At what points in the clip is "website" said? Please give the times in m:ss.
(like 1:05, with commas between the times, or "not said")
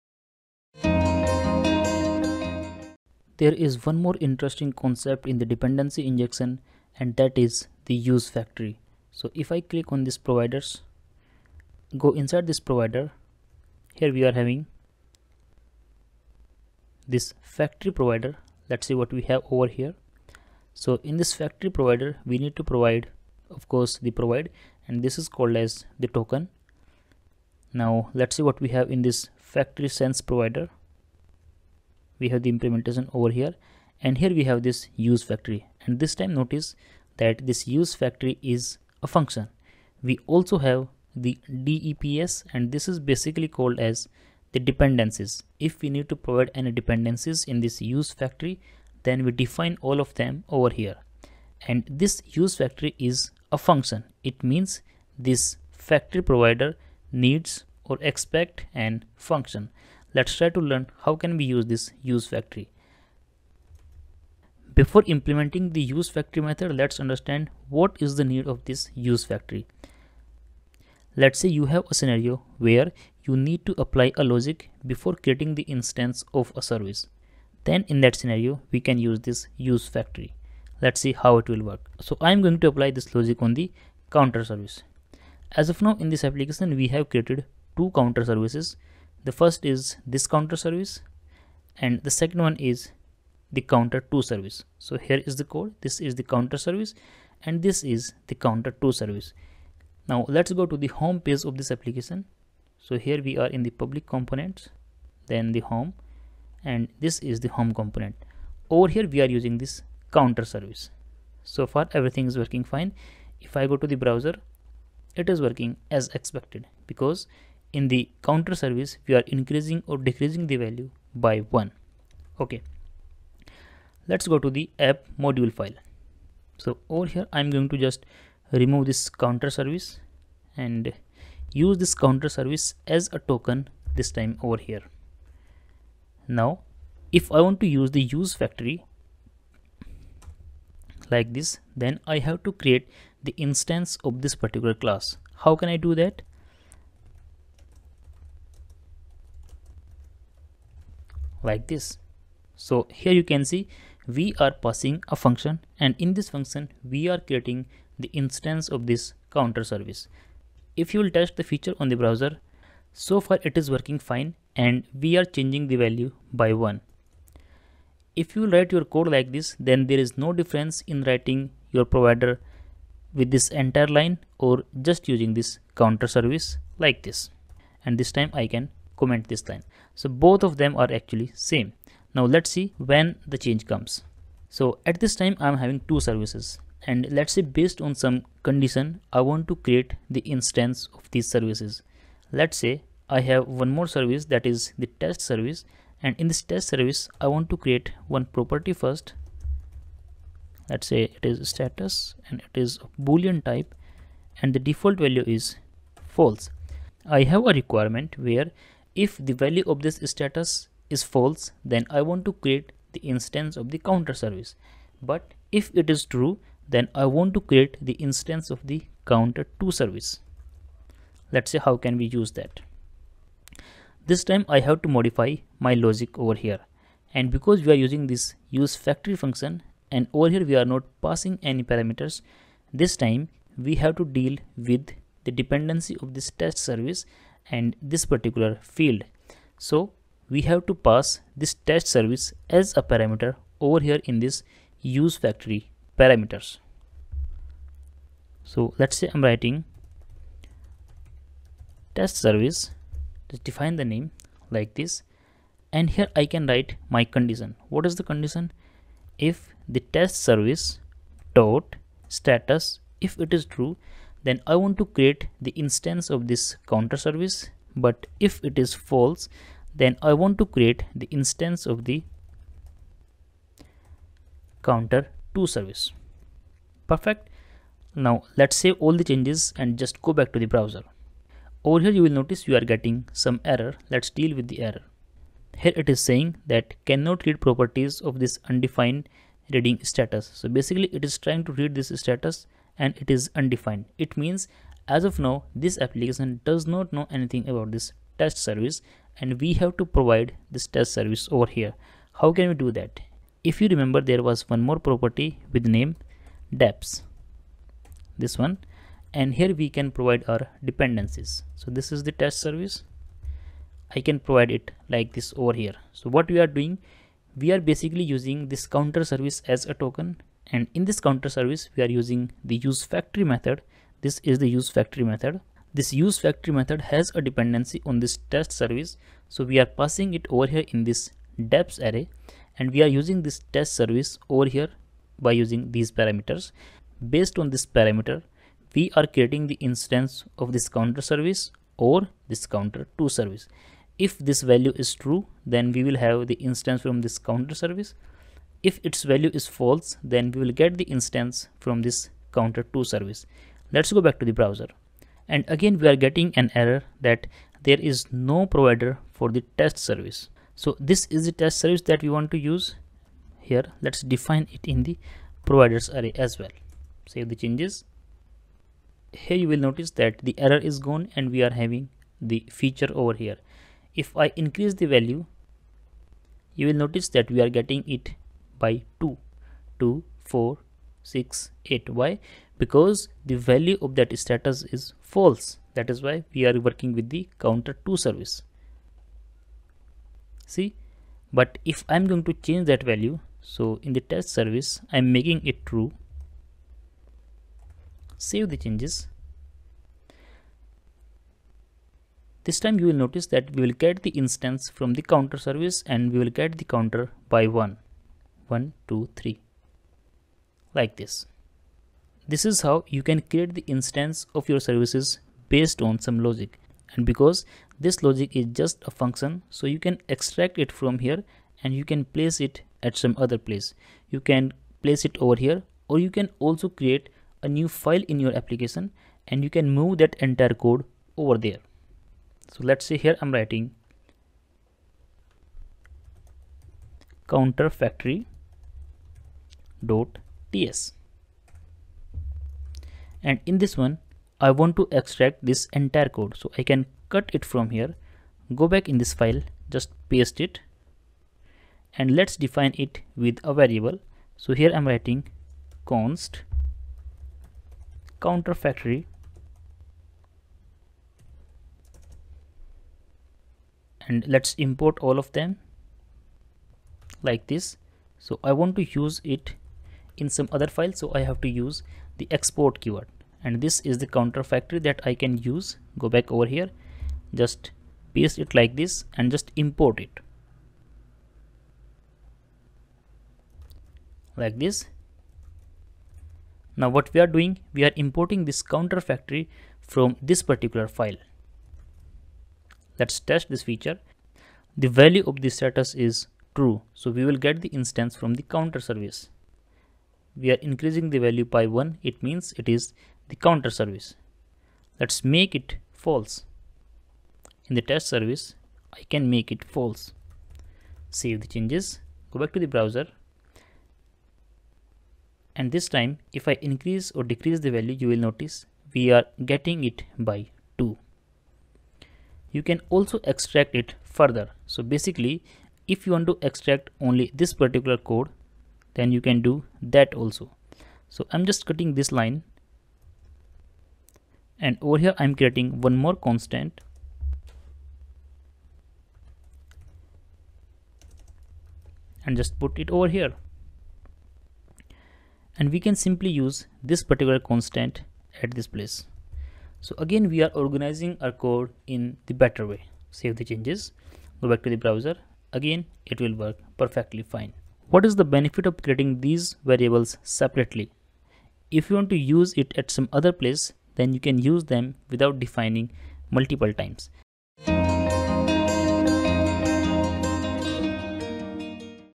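not said.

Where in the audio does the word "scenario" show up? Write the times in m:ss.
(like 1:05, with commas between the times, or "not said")
1:11, 1:18.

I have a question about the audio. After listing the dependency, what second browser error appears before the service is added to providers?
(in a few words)
no provider for the test service.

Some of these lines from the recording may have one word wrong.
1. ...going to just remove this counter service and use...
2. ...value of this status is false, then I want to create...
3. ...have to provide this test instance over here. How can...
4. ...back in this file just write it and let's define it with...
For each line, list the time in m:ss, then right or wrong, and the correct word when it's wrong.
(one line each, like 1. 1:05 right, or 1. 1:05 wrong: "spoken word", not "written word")
1. 2:07 right
2. 3:29 right
3. 4:59 wrong: "service", not "instance"
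4. 7:28 wrong: "paste", not "write".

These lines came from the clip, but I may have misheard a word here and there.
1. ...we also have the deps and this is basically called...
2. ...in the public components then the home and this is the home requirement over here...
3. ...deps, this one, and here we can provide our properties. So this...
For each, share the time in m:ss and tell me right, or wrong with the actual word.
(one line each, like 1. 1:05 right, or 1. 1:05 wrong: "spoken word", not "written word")
1. 0:40 right
2. 1:43 wrong: "component", not "requirement"
3. 5:06 wrong: "dependencies", not "properties".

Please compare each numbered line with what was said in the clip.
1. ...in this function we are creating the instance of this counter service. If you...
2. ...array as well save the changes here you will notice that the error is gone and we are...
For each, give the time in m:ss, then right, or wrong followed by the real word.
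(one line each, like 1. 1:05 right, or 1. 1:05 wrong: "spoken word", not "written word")
1. 2:35 right
2. 6:06 right.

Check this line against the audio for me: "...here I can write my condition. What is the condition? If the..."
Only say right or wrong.
right.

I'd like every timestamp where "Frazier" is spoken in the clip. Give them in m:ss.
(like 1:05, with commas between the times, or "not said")
not said.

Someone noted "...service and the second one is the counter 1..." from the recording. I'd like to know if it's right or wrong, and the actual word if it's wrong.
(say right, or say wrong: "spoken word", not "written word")
wrong: "2", not "1".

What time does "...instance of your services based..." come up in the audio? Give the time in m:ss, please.
6:53.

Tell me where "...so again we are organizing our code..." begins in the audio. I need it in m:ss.
9:09.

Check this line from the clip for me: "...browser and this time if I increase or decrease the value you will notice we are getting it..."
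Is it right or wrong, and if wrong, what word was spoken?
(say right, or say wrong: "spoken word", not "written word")
right.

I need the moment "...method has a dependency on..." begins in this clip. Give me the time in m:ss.
5:26.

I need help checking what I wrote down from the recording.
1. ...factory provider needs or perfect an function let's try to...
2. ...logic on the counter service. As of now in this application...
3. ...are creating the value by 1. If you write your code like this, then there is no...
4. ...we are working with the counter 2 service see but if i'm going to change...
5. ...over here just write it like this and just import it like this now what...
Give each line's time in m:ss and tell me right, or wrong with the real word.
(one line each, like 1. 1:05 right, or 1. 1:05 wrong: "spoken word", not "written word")
1. 0:55 wrong: "expect", not "perfect"
2. 1:23 right
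3. 2:45 wrong: "changing", not "creating"
4. 6:26 right
5. 7:56 wrong: "paste", not "write".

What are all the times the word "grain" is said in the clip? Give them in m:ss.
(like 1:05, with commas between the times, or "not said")
not said.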